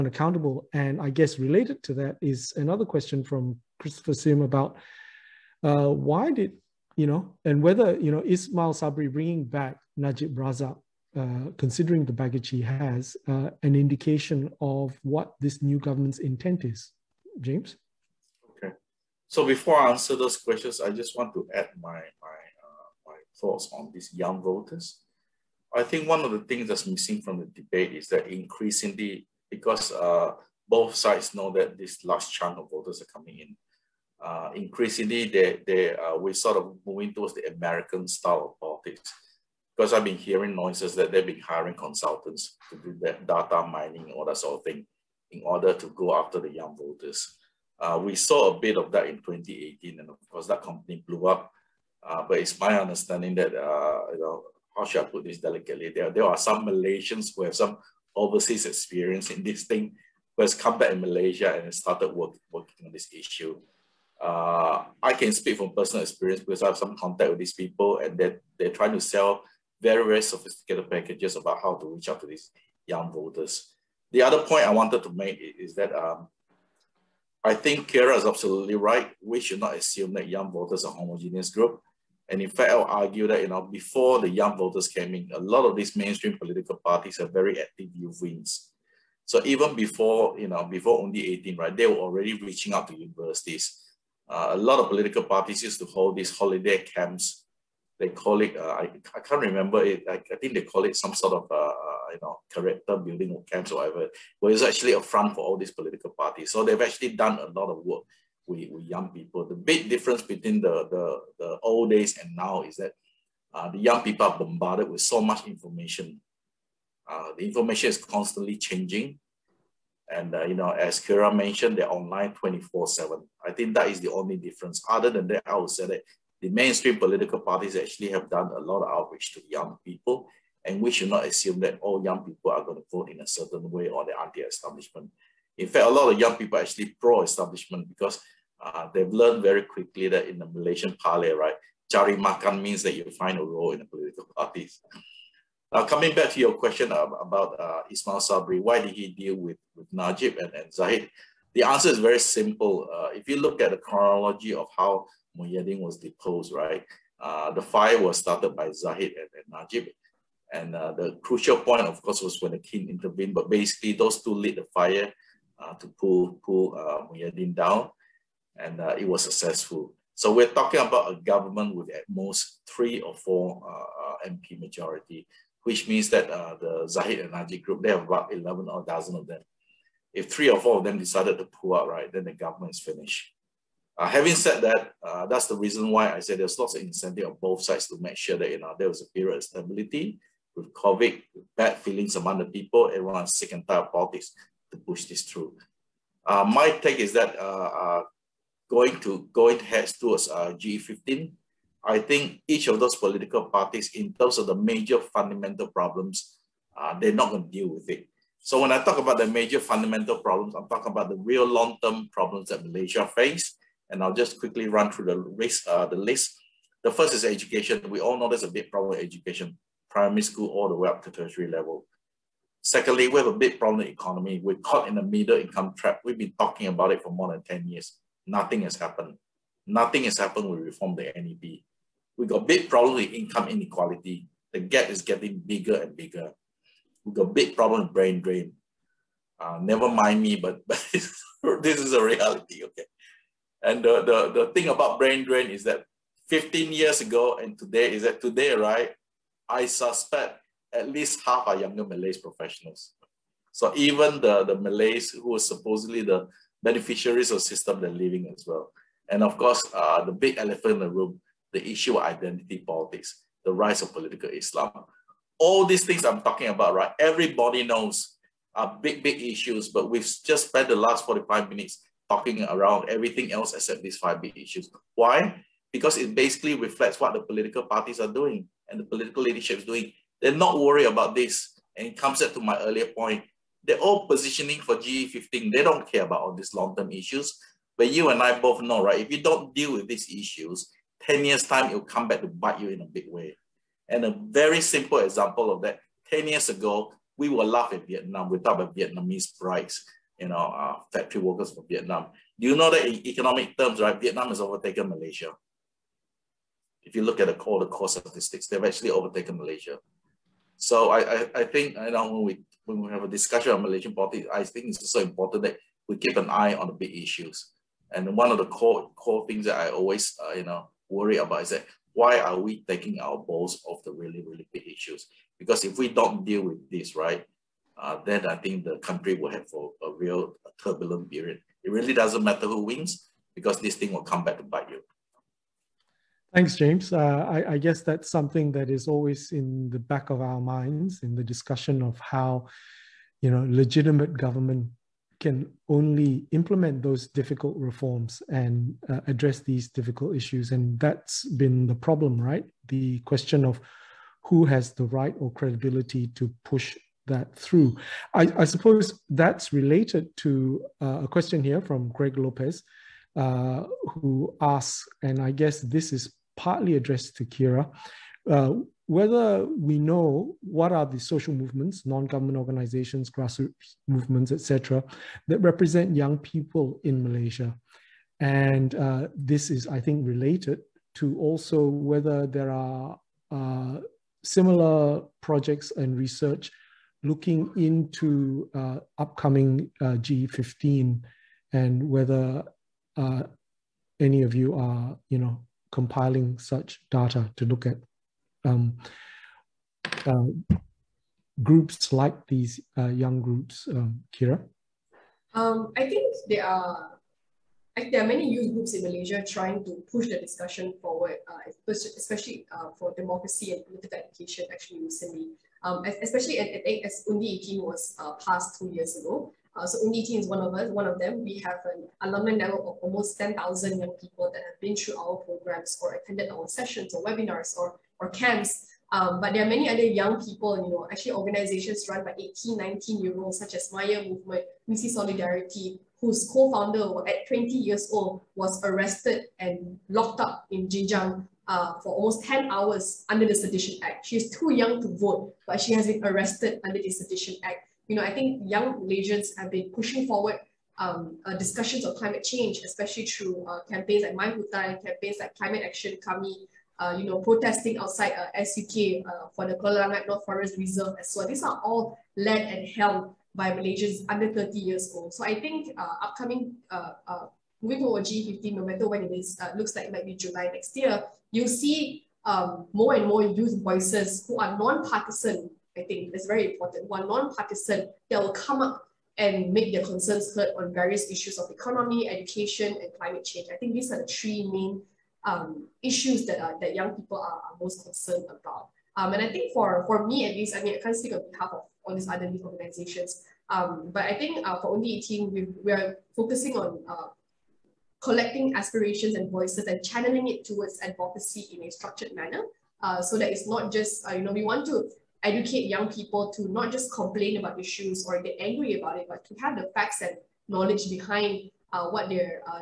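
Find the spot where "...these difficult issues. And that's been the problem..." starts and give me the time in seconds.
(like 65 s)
349 s.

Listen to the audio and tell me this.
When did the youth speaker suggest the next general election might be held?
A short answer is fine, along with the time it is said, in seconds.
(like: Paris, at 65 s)
July next year, at 470 s.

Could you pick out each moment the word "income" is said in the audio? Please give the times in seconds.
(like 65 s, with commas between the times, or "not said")
225 s, 233 s.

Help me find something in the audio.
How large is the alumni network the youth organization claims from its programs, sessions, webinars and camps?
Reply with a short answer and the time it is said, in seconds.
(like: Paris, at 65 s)
almost 10,000, at 422 s.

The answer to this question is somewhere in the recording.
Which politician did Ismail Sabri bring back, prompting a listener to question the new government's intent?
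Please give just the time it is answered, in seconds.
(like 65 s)
9 s.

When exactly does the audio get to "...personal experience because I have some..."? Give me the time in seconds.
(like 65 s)
65 s.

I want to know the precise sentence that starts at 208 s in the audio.
So when I talk about the major fundamental problems, I'm talking about the real long-term problems that Malaysia face.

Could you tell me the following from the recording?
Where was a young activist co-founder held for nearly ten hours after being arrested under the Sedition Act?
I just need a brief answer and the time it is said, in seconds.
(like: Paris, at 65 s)
Jinjang, at 440 s.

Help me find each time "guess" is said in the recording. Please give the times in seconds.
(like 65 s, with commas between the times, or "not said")
1 s, 337 s, 365 s.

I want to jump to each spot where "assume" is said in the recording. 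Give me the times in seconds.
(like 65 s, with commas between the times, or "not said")
79 s, 131 s.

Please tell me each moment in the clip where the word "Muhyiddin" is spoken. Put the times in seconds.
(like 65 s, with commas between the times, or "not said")
155 s, 167 s.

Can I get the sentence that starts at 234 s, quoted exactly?
The gap is getting bigger and bigger.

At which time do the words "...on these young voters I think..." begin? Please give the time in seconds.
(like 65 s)
23 s.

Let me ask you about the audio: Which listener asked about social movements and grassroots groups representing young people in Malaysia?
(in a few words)
Greg Lopez.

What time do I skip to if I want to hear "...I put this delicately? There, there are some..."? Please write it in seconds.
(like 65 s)
54 s.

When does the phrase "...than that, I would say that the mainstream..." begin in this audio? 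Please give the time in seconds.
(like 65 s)
125 s.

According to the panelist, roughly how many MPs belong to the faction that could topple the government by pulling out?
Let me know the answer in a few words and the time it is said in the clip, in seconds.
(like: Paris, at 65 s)
11 or a dozen, at 178 s.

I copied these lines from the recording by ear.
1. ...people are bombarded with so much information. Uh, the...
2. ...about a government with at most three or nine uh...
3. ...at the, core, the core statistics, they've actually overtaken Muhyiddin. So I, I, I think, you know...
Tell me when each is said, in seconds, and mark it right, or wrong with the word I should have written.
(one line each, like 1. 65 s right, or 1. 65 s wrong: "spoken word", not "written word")
1. 114 s right
2. 170 s wrong: "four", not "nine"
3. 307 s wrong: "Malaysia", not "Muhyiddin".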